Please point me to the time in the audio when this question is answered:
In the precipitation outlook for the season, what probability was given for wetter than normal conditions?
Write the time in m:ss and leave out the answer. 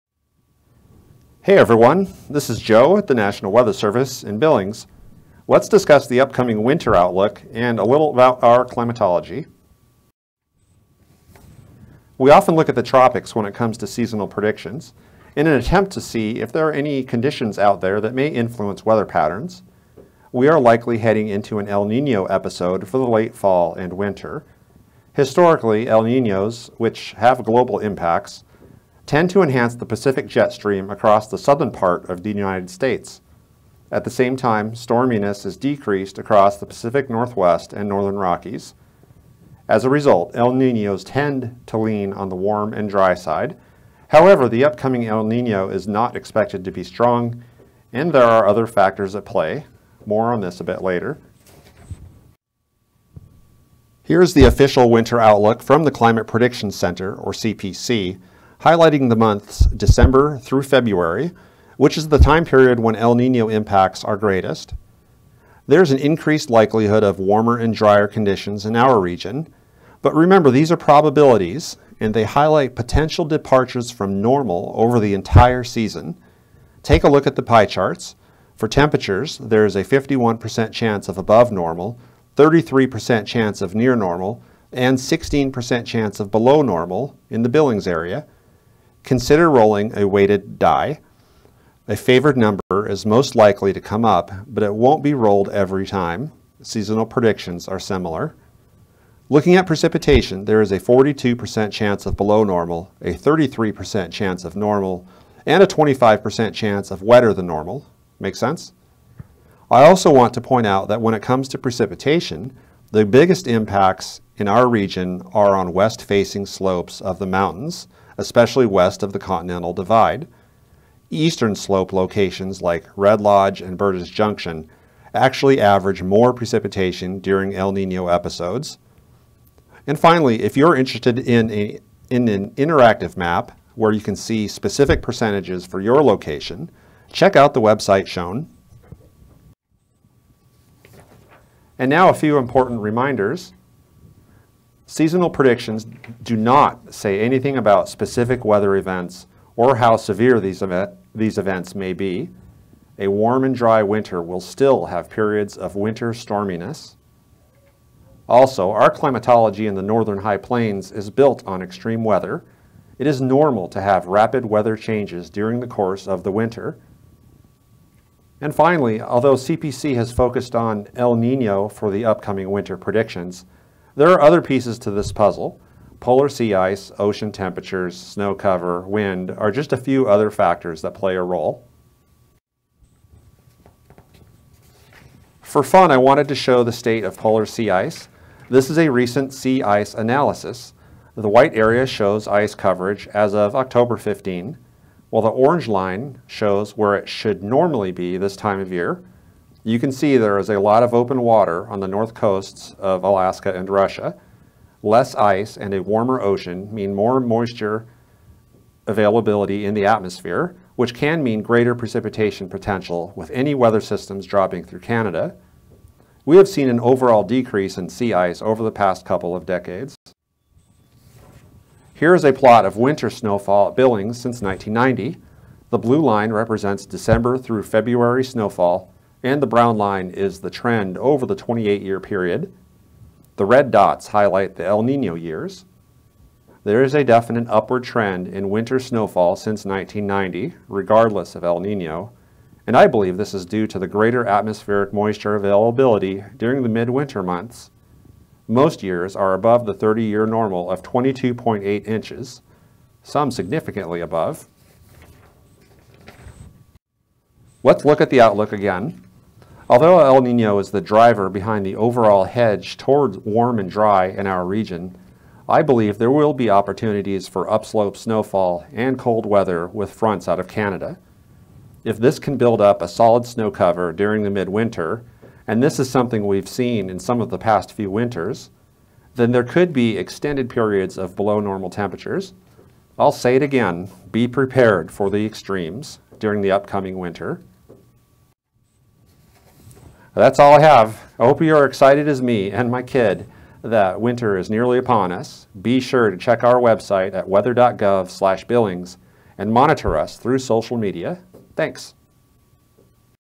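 1:45.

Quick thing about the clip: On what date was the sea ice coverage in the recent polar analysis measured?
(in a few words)
October 15.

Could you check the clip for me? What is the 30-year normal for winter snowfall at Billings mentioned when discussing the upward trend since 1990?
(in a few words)
22.8 inches.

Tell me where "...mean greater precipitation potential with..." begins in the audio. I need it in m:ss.
3:31.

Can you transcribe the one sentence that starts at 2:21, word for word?
And now a few important reminders.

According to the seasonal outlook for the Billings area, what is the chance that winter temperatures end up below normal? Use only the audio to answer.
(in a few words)
16%.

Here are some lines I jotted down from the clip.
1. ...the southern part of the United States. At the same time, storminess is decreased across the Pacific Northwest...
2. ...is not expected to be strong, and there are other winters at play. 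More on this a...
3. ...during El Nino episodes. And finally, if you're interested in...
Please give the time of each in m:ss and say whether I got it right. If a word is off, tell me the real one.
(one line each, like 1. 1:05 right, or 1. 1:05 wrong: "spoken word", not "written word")
1. 0:31 right
2. 0:45 wrong: "factors", not "winters"
3. 2:07 right.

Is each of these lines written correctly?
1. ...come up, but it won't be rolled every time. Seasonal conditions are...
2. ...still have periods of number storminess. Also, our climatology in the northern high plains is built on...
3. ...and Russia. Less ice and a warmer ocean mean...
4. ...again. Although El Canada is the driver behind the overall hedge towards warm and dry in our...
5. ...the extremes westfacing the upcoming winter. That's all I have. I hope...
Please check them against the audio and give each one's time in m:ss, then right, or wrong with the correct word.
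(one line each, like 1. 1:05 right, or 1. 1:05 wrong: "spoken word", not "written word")
1. 1:33 wrong: "predictions", not "conditions"
2. 2:34 wrong: "winter", not "number"
3. 3:23 right
4. 4:18 wrong: "Nino", not "Canada"
5. 4:45 wrong: "during", not "westfacing".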